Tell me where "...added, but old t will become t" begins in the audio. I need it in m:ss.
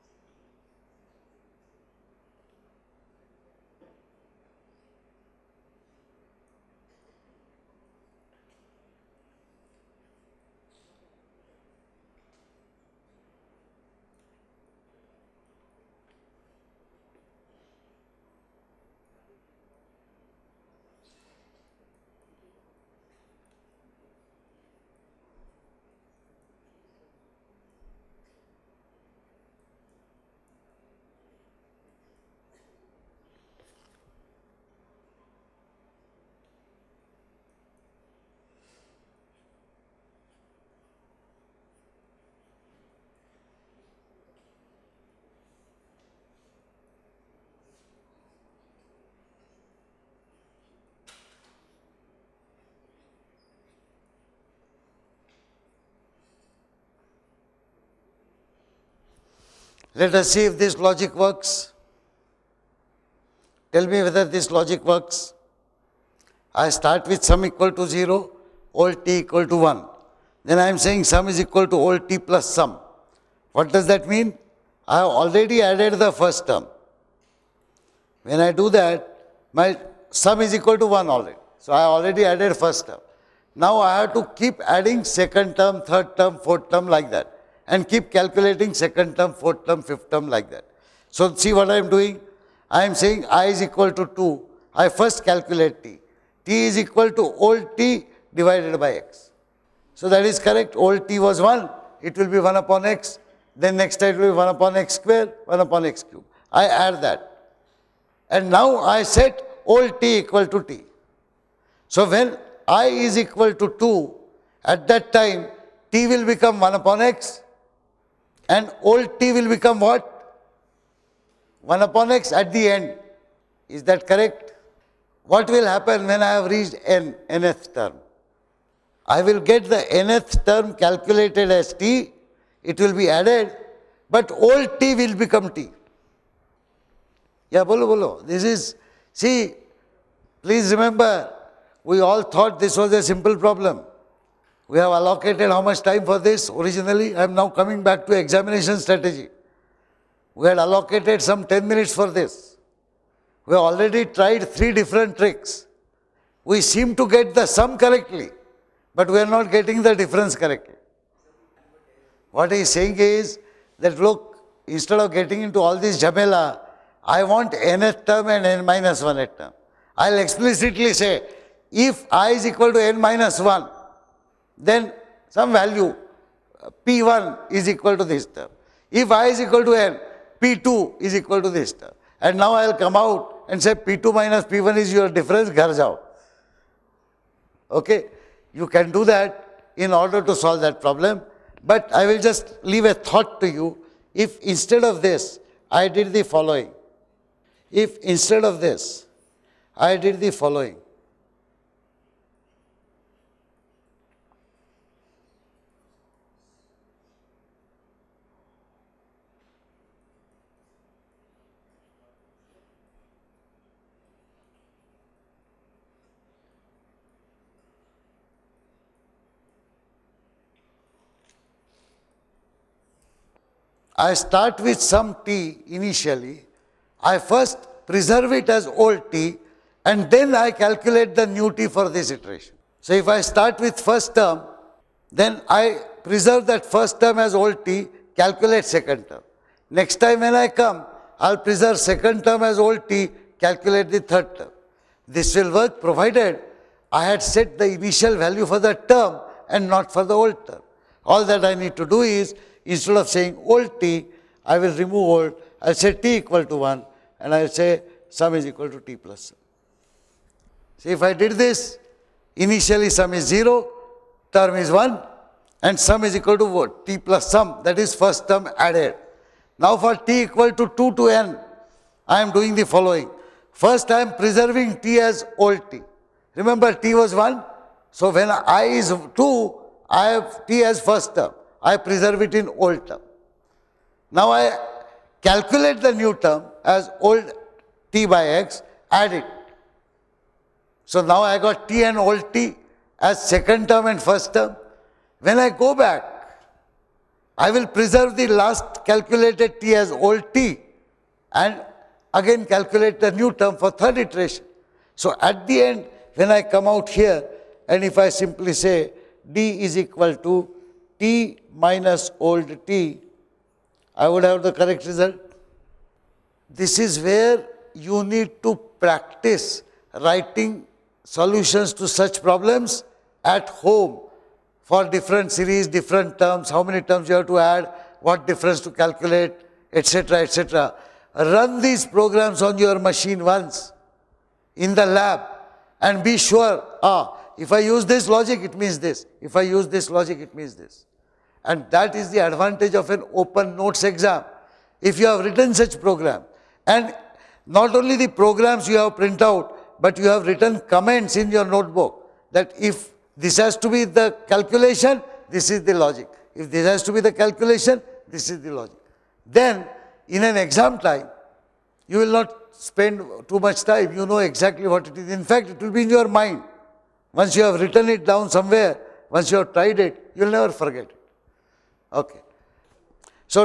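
2:13.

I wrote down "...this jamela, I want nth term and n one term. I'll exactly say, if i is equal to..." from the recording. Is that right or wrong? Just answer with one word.
wrong.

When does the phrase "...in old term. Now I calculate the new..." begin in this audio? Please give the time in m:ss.
4:42.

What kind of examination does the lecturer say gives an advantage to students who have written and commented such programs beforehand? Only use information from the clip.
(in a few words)
open notes exam.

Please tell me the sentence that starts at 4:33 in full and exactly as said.
First, I am preserving t as old t.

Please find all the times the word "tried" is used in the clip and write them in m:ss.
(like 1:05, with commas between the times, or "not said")
2:34, 6:09.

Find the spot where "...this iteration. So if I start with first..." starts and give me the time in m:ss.
3:51.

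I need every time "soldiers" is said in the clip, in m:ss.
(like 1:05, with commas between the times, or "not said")
not said.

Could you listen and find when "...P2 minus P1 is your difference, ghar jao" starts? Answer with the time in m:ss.
3:03.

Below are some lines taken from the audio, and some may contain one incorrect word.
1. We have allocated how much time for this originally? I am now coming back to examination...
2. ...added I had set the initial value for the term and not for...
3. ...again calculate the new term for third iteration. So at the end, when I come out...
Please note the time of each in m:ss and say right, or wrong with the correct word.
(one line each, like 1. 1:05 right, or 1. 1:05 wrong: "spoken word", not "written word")
1. 2:24 right
2. 4:05 wrong: "provided", not "added"
3. 5:02 right.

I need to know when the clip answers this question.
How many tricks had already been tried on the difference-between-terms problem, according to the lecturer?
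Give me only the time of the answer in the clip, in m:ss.
2:34.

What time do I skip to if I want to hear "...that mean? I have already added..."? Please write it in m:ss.
1:13.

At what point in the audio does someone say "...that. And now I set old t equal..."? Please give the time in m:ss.
1:47.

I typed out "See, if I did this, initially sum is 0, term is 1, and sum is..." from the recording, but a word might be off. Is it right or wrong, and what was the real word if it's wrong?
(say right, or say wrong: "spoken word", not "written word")
right.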